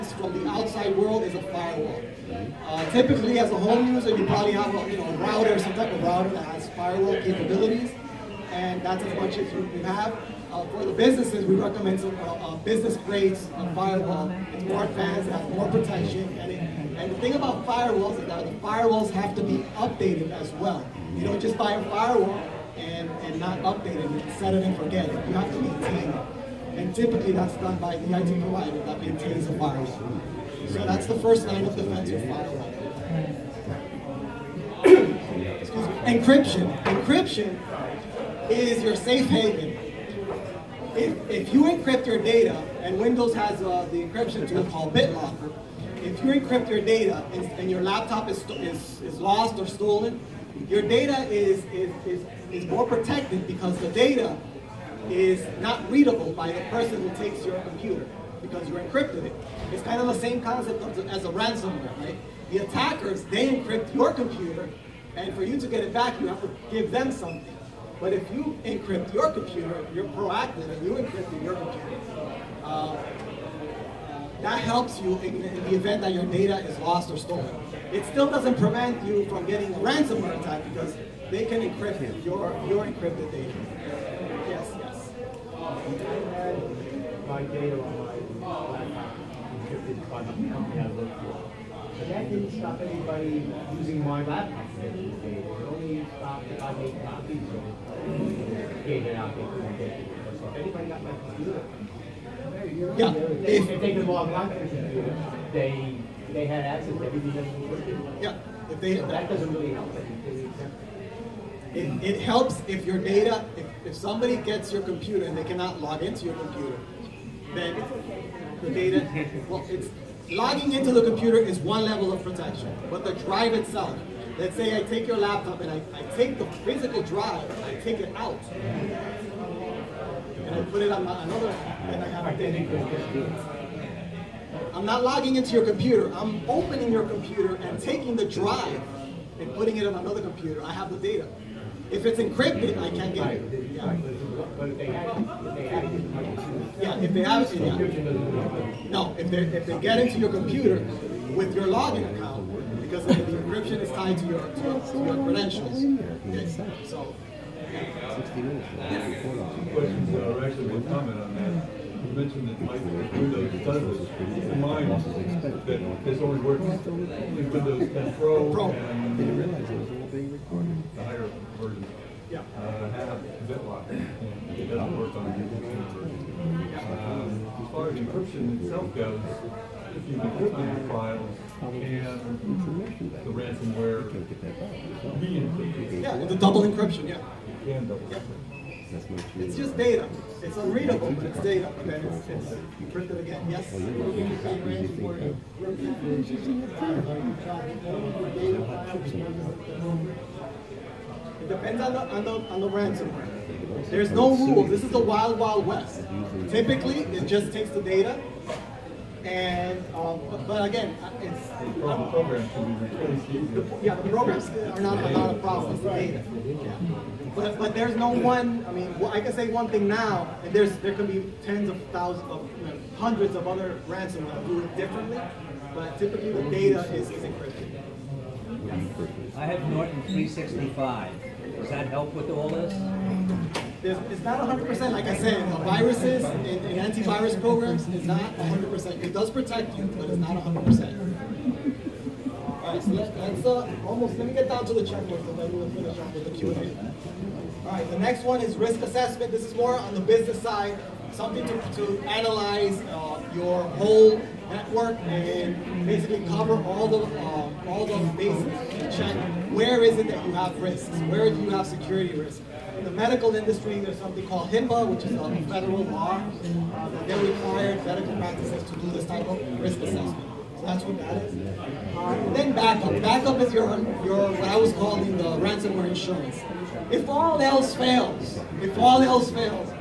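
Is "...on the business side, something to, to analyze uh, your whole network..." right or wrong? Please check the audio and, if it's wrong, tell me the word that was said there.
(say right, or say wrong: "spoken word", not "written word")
right.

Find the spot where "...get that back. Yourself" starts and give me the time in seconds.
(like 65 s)
184 s.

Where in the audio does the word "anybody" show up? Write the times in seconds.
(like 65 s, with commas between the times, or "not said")
92 s, 100 s.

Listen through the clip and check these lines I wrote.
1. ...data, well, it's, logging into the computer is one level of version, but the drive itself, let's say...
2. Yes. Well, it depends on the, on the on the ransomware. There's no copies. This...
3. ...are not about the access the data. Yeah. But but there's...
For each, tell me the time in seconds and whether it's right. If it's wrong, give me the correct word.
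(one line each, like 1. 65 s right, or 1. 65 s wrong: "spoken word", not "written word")
1. 118 s wrong: "protection", not "version"
2. 193 s wrong: "rules", not "copies"
3. 214 s wrong: "process", not "access".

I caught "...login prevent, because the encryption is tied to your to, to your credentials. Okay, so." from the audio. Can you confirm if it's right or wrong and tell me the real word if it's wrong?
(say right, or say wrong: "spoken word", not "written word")
wrong: "account", not "prevent".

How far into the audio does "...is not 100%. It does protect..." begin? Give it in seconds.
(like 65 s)
237 s.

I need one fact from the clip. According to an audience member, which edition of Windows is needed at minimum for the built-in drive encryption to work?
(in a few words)
Windows 10 Pro.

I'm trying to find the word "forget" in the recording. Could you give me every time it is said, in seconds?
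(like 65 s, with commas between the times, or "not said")
24 s.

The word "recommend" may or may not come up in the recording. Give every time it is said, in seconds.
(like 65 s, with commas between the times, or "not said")
11 s.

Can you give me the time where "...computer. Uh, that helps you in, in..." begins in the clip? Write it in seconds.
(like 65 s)
71 s.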